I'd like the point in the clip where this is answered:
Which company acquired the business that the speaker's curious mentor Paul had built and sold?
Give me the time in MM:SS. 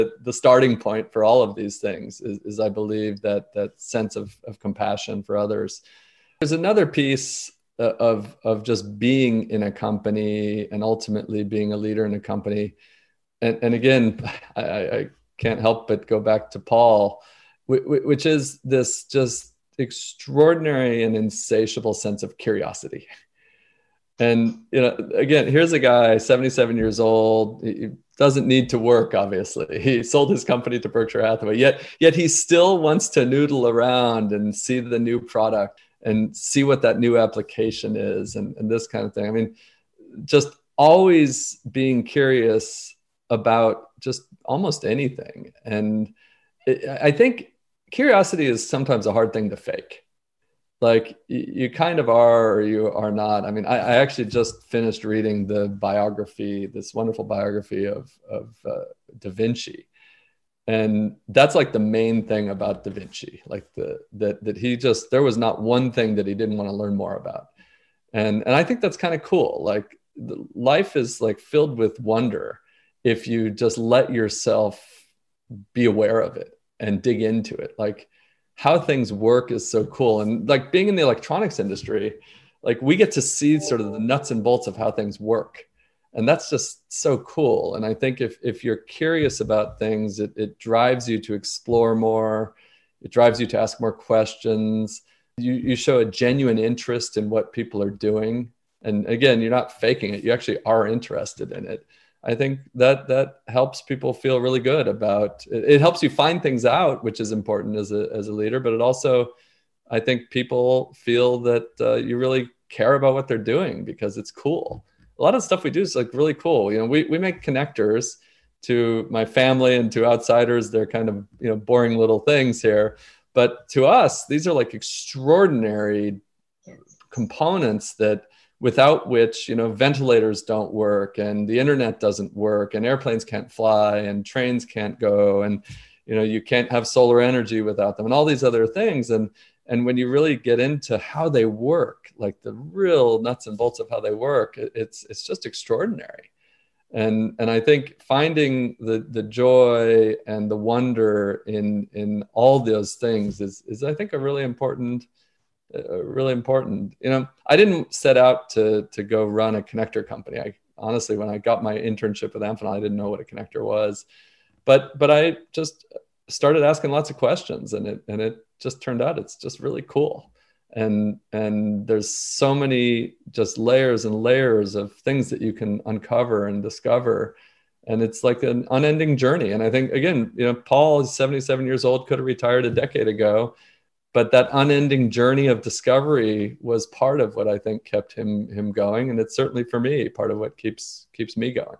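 00:30.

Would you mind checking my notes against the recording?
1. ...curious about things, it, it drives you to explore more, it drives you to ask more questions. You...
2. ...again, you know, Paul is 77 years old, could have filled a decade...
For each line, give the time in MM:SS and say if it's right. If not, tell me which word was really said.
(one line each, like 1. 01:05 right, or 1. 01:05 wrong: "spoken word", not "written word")
1. 01:28 right
2. 02:59 wrong: "retired", not "filled".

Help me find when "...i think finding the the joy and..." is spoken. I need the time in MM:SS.
02:27.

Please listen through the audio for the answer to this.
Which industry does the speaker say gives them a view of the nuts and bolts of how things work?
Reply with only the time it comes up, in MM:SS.
01:21.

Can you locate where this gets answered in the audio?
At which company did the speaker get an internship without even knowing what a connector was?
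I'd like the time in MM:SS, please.
02:42.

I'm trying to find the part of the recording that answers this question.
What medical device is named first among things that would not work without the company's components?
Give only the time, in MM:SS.
02:09.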